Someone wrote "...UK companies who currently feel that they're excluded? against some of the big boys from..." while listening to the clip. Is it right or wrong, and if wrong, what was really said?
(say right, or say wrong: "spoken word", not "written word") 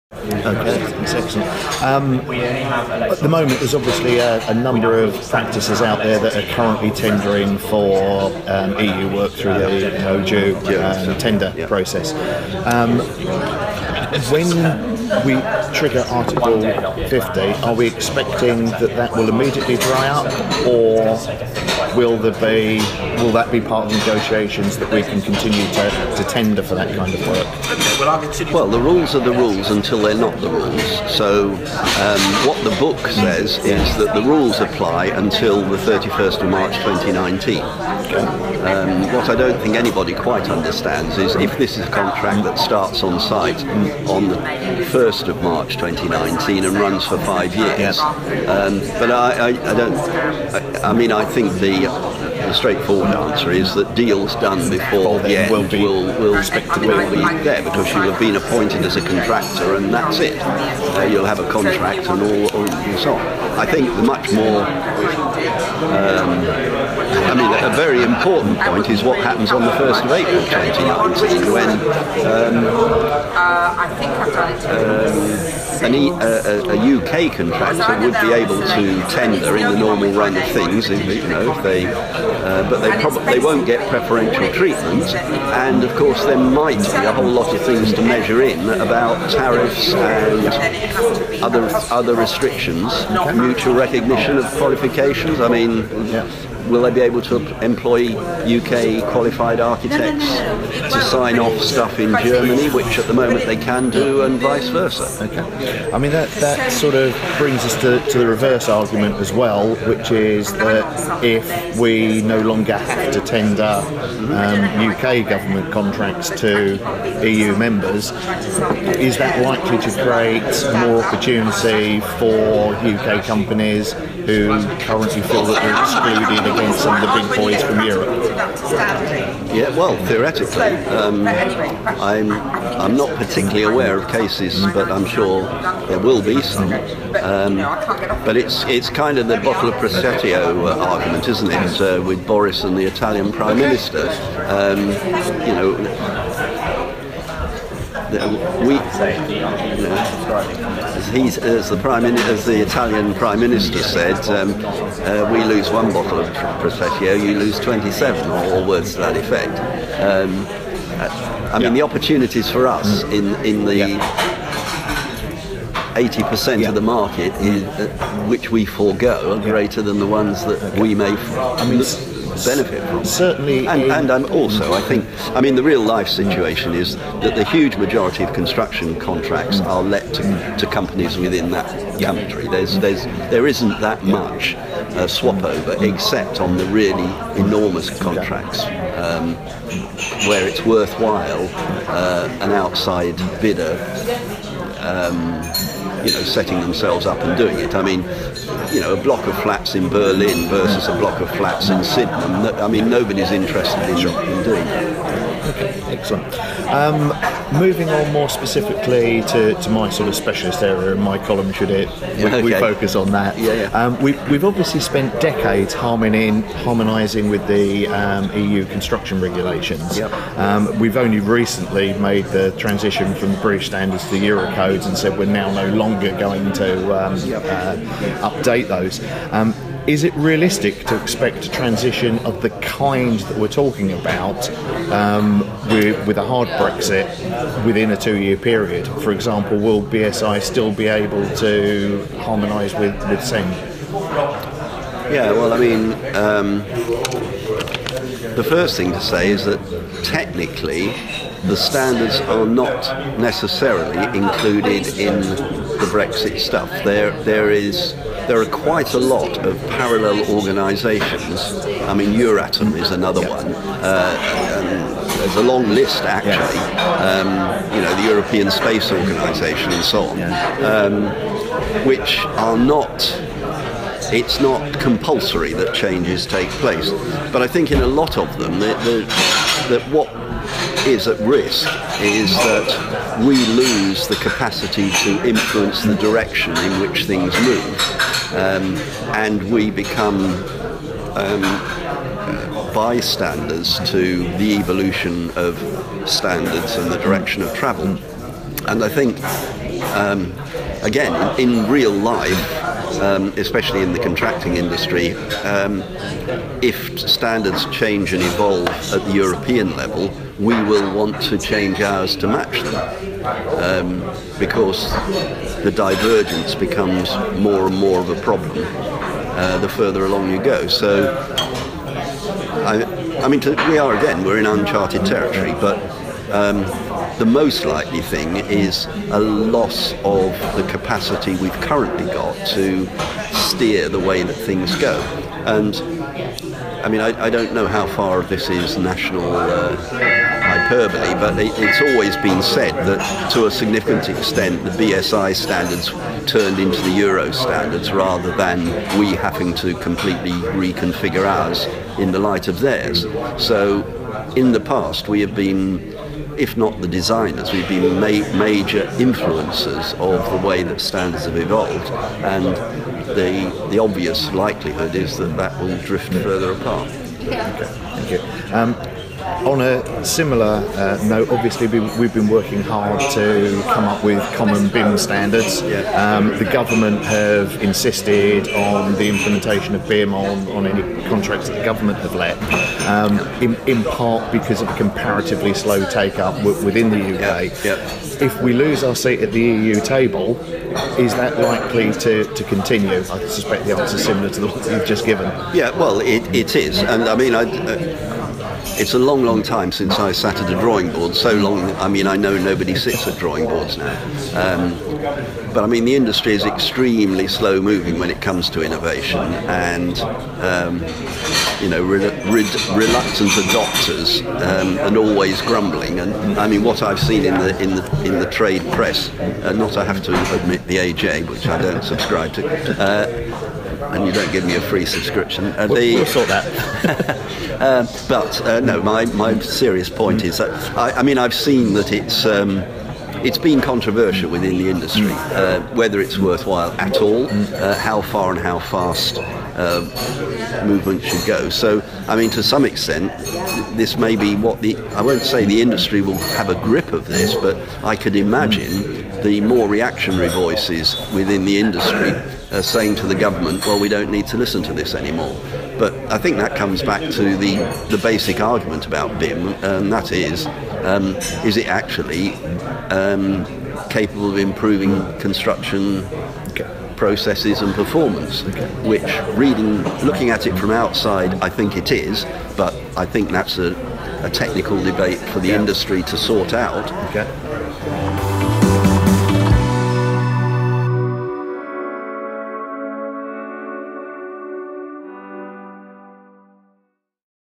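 right.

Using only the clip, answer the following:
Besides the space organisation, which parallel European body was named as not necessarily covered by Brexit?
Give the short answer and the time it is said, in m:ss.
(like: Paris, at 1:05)
Euratom, at 4:22.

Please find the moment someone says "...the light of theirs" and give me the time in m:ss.
5:52.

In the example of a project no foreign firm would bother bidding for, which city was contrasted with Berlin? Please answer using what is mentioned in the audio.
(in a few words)
Sydney.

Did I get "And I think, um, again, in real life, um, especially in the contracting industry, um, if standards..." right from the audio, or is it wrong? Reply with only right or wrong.
right.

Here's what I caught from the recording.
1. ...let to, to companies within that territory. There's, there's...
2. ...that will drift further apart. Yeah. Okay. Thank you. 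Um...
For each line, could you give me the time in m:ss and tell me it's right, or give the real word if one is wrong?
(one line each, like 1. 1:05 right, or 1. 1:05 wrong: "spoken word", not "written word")
1. 2:59 wrong: "country", not "territory"
2. 6:05 right.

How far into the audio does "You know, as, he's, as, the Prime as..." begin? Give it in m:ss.
2:29.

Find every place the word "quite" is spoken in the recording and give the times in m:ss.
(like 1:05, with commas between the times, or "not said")
0:40, 4:18.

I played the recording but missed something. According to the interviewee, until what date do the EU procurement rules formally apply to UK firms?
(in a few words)
31st of March 2019.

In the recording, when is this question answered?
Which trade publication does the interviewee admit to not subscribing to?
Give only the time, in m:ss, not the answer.
7:00.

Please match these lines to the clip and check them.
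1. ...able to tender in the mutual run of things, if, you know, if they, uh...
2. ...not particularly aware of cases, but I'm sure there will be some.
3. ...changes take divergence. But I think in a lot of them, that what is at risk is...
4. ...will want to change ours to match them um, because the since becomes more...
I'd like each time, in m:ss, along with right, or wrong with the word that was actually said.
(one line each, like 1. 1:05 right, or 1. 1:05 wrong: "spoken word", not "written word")
1. 1:18 wrong: "normal", not "mutual"
2. 2:12 right
3. 4:35 wrong: "place", not "divergence"
4. 5:10 wrong: "divergence", not "since".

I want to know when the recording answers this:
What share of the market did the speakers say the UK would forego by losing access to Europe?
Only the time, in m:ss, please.
2:45.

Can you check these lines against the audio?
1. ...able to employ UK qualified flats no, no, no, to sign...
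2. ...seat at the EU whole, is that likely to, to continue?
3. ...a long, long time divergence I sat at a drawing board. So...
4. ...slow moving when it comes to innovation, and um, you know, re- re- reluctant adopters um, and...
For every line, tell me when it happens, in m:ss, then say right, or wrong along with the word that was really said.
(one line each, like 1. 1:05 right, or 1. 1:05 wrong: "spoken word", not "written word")
1. 1:37 wrong: "architects", not "flats"
2. 6:28 wrong: "table", not "whole"
3. 6:38 wrong: "since", not "divergence"
4. 6:47 right.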